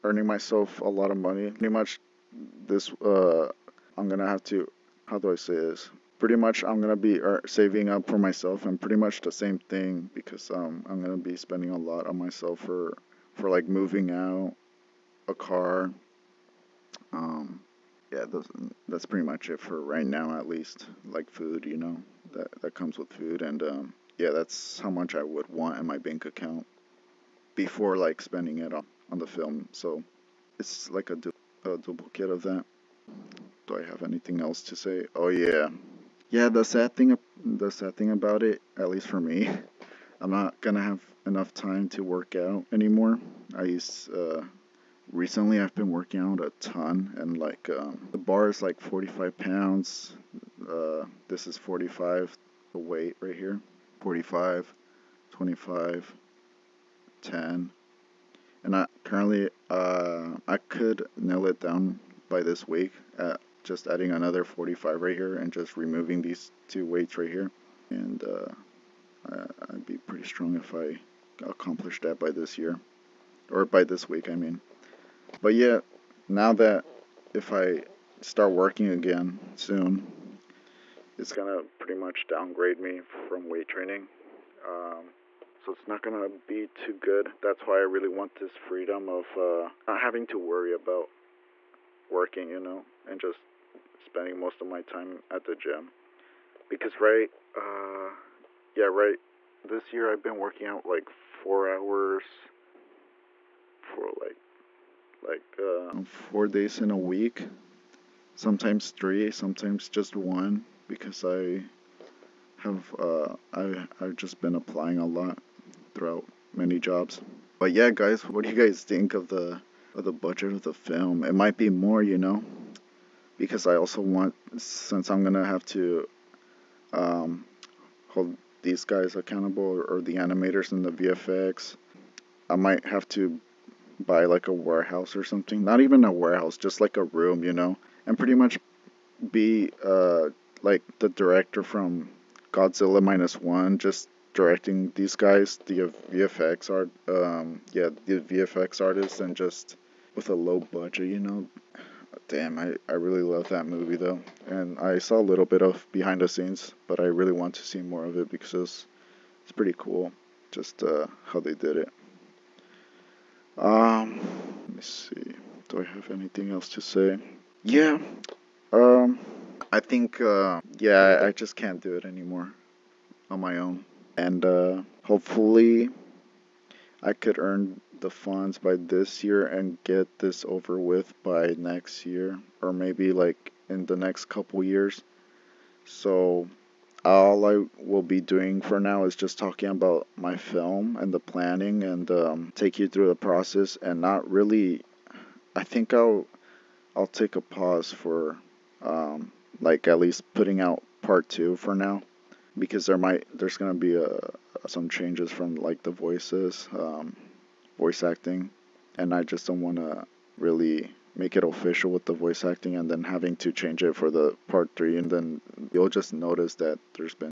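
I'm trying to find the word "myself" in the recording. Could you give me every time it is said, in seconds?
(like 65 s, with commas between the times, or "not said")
0 s, 8 s, 12 s.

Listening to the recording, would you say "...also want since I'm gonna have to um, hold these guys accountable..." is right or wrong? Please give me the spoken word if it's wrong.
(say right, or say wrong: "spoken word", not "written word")
right.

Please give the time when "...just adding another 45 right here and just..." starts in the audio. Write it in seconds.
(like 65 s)
63 s.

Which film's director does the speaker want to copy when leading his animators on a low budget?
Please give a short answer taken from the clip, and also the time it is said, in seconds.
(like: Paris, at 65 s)
Godzilla Minus One, at 142 s.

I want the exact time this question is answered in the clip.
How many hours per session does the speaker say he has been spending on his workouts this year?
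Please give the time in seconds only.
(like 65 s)
101 s.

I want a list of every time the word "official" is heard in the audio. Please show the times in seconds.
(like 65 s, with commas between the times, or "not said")
211 s.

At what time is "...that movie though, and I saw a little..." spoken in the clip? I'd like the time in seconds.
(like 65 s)
153 s.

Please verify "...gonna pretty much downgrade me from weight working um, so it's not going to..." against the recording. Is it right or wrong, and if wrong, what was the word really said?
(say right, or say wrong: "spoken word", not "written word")
wrong: "training", not "working".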